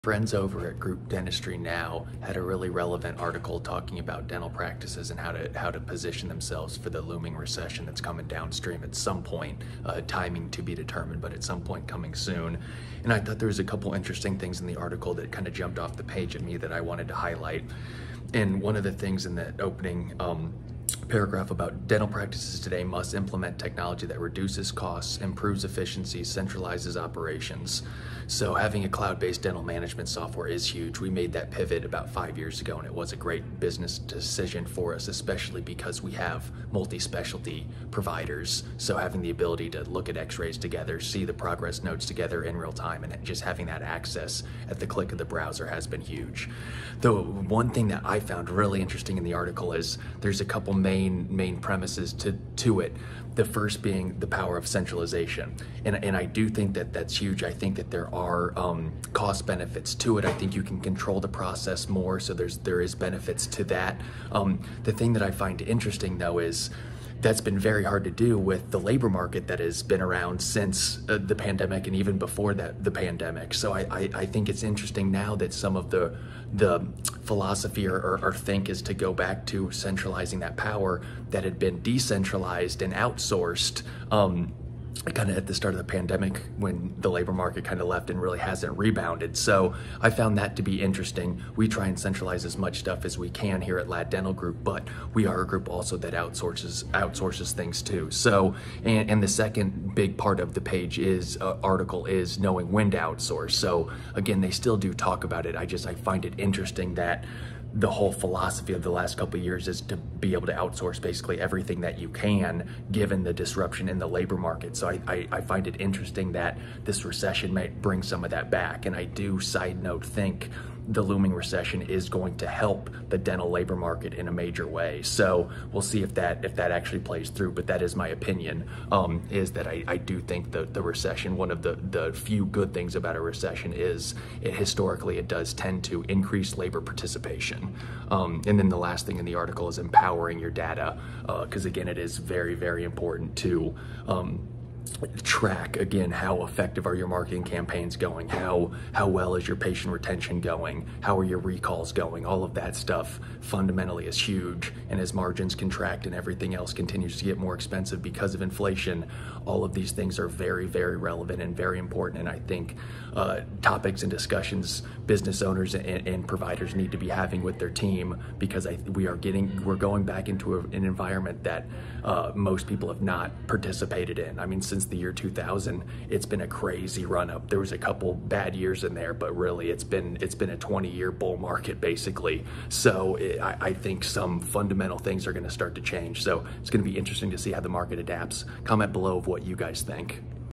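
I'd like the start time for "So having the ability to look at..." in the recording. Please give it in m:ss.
0:38.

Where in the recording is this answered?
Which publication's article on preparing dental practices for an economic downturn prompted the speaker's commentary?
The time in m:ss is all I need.
0:00.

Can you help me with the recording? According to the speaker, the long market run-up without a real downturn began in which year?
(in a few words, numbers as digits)
2000.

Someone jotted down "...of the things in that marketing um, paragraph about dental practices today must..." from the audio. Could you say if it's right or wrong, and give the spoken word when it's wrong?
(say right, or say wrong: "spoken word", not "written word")
wrong: "opening", not "marketing".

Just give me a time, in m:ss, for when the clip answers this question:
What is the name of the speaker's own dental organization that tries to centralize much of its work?
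1:33.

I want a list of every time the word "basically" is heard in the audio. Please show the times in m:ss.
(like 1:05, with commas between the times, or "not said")
1:51, 3:01.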